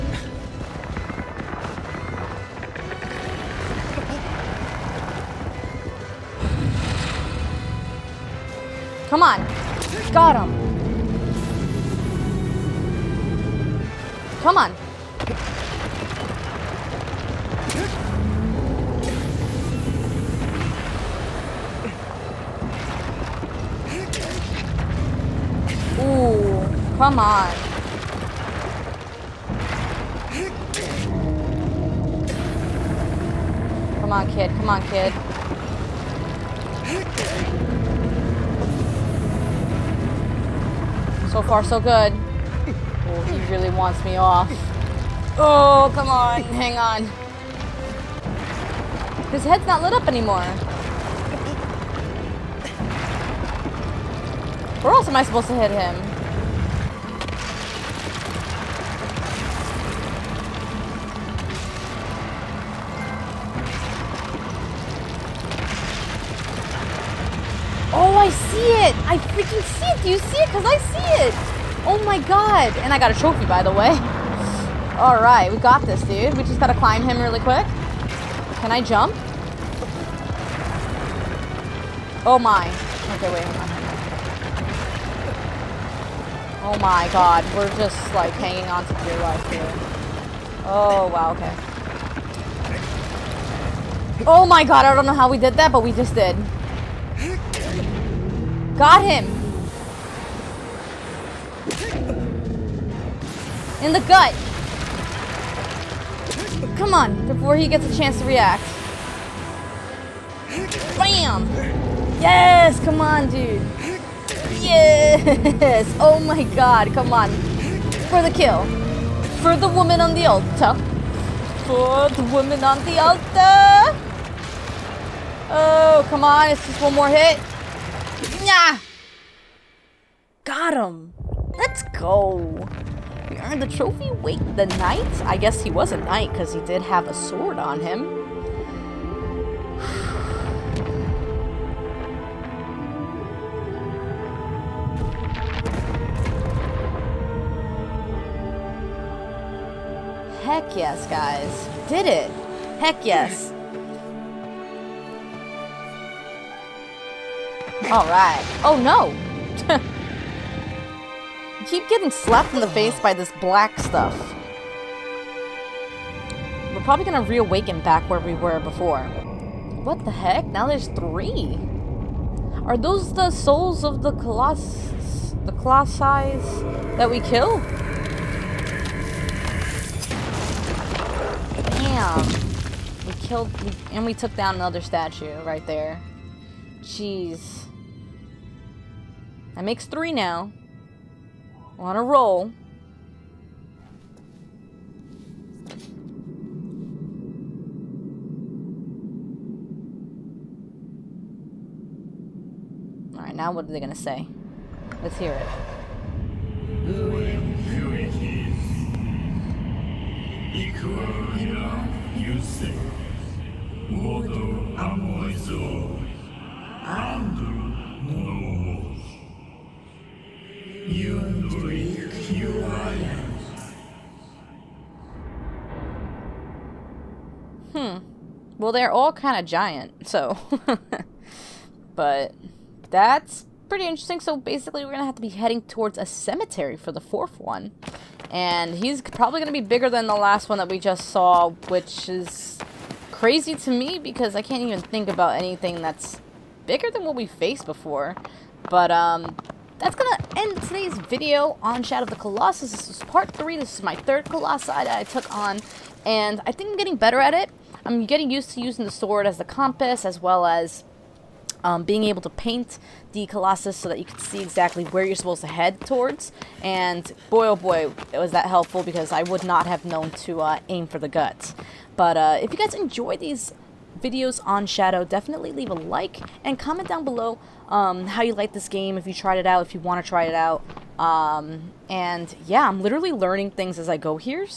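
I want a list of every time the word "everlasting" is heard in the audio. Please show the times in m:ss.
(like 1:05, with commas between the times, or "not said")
not said.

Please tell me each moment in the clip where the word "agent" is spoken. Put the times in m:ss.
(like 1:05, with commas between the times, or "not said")
not said.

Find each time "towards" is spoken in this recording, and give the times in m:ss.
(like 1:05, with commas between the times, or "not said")
3:55, 4:25.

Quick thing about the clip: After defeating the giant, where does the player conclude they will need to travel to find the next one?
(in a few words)
A cemetery.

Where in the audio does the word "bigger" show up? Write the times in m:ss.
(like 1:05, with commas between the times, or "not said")
3:59, 4:06.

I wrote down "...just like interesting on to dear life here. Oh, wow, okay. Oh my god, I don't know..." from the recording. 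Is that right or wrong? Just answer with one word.
wrong.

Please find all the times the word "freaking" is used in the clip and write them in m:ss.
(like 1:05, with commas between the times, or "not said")
1:09.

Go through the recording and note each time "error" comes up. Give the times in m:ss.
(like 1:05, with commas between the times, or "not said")
not said.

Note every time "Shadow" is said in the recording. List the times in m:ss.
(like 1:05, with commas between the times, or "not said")
4:11, 4:34.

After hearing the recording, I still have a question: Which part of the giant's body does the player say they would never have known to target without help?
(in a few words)
The guts.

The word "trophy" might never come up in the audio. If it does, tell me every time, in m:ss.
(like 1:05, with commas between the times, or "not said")
1:13, 2:13.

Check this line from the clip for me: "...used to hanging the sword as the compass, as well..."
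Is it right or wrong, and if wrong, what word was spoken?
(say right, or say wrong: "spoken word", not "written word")
wrong: "using", not "hanging".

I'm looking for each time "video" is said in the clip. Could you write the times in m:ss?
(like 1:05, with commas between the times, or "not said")
4:10, 4:34.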